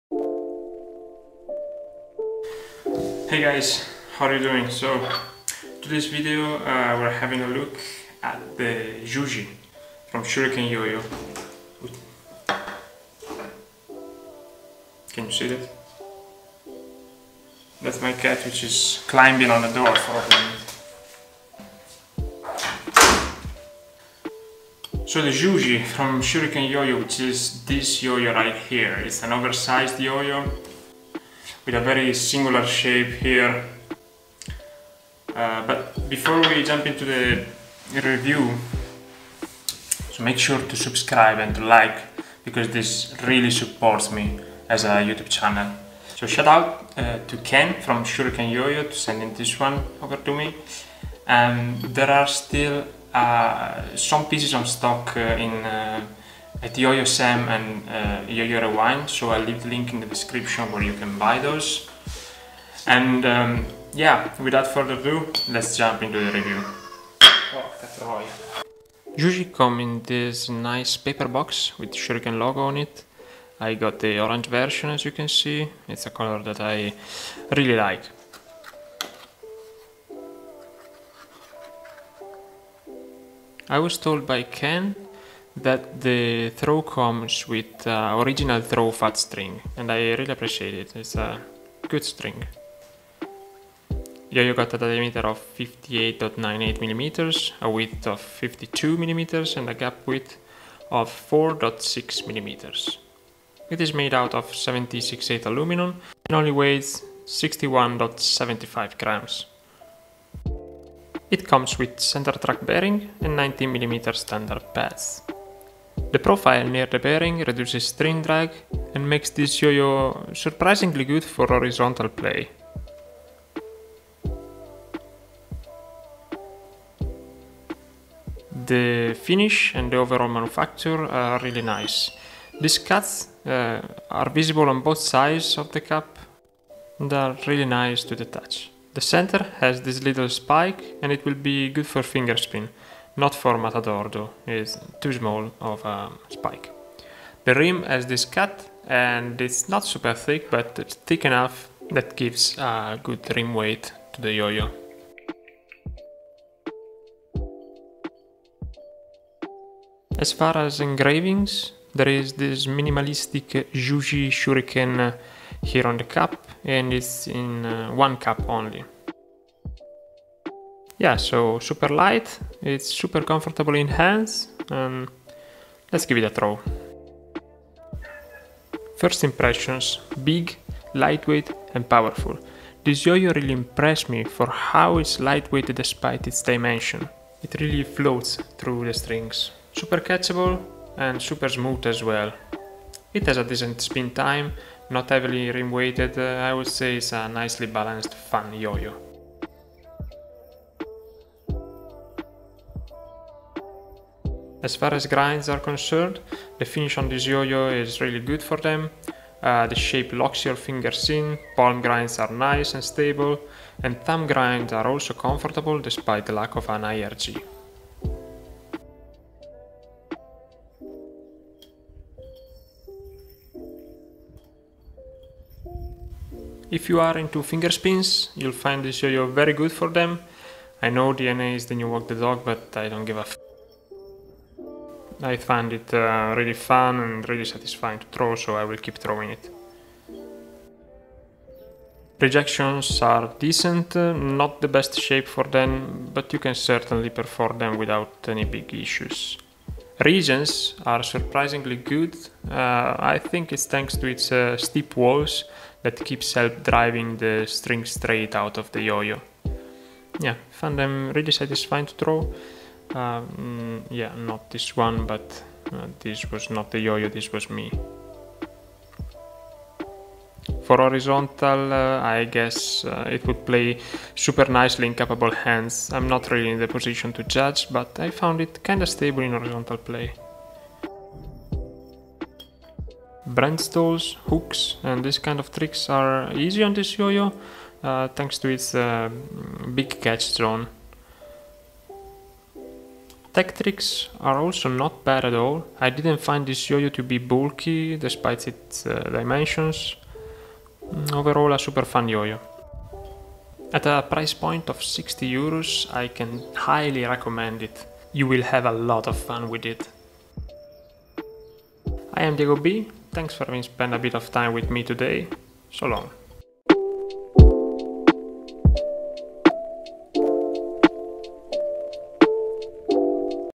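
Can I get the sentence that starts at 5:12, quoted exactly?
I am Diego B, thanks for having spent a bit of time with me today.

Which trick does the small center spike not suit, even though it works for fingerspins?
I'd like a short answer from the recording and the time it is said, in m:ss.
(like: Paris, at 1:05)
Matador, at 2:23.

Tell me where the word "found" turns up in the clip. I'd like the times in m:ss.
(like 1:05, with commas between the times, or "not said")
4:20, 4:38.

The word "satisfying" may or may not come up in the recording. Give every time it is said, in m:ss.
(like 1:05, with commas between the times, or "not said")
3:57, 4:21.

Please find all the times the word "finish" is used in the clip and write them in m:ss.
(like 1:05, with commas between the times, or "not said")
2:09, 3:26.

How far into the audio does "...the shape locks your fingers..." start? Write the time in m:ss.
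3:29.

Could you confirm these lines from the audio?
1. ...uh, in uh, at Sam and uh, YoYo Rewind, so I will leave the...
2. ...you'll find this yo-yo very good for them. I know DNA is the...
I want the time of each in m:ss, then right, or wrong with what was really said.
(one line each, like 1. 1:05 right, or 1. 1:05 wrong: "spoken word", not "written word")
1. 0:55 right
2. 3:48 right.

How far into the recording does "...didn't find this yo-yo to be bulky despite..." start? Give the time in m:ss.
4:55.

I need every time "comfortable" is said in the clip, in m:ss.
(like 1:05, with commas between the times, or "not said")
2:53, 3:35.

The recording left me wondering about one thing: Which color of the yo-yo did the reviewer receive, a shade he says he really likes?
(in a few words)
orange.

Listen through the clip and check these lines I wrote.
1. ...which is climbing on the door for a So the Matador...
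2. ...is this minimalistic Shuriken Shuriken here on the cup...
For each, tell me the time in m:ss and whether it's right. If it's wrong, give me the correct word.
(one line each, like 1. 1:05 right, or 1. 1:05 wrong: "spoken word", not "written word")
1. 0:18 wrong: "Juji", not "Matador"
2. 2:42 wrong: "Juji", not "Shuriken".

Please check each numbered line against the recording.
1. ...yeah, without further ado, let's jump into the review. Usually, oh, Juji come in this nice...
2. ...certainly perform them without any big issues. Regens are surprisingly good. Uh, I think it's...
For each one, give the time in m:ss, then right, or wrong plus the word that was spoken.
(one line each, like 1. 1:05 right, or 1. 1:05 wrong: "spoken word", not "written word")
1. 1:03 right
2. 4:06 right.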